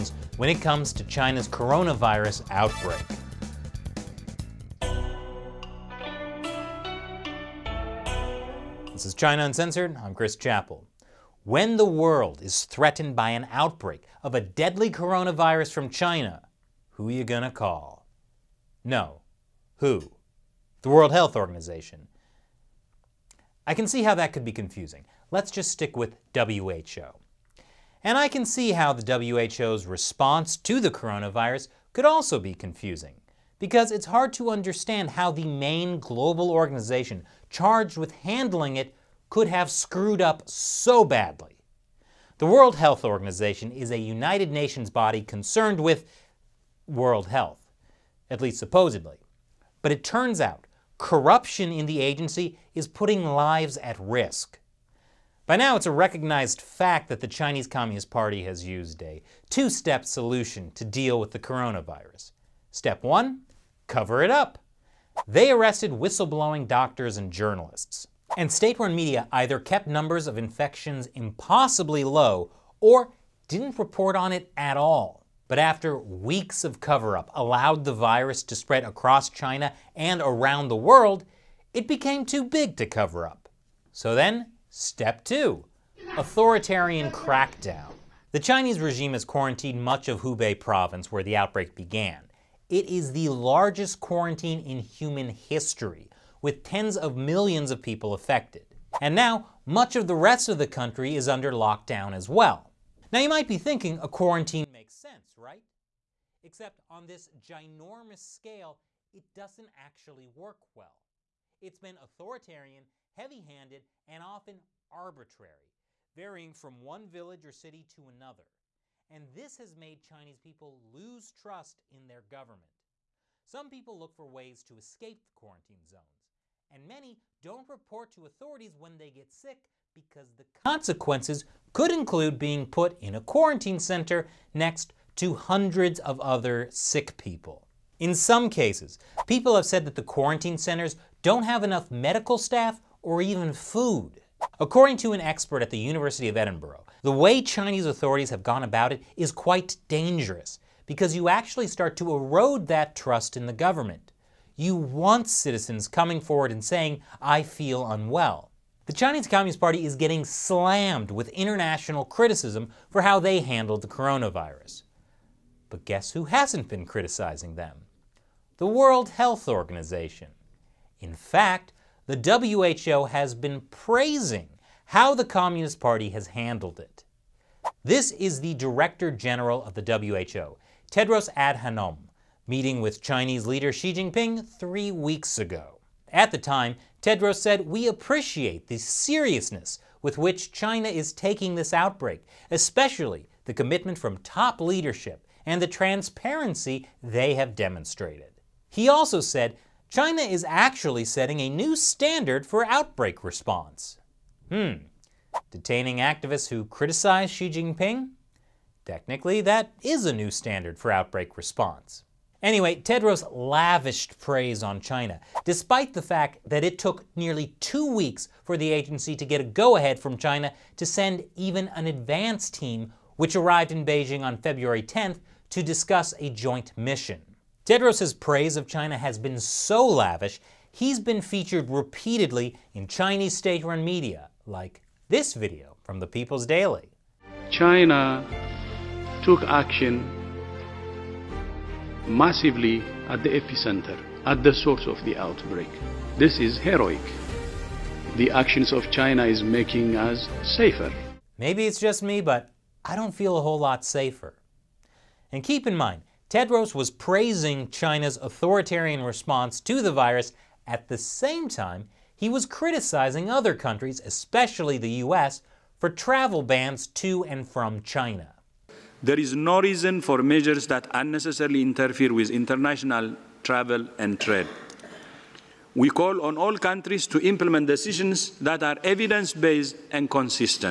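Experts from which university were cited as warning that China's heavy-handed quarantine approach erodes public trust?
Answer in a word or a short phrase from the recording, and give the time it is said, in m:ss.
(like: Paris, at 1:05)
University of Edinburgh, at 2:25.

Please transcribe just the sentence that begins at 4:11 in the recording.
Maybe it's just me, but I don't feel a whole lot safer.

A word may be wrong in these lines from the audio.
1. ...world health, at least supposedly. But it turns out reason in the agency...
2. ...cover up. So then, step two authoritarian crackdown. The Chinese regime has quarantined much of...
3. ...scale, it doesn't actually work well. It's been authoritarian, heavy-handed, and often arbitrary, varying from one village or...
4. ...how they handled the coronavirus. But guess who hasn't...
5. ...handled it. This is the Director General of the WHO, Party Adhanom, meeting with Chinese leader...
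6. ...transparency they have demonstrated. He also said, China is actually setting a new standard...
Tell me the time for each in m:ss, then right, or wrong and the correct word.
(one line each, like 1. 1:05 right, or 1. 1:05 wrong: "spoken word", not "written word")
1. 0:46 wrong: "corruption", not "reason"
2. 1:22 right
3. 1:48 right
4. 2:43 right
5. 2:56 wrong: "Tedros", not "Party"
6. 3:15 right.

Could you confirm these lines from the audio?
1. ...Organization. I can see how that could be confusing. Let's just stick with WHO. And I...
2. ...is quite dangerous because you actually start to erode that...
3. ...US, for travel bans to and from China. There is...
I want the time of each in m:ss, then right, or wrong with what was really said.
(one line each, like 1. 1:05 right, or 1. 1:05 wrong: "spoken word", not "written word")
1. 0:21 right
2. 2:29 right
3. 4:25 right.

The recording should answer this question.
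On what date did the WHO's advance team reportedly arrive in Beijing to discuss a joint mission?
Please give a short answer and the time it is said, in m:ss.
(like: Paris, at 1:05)
February 10th, at 3:44.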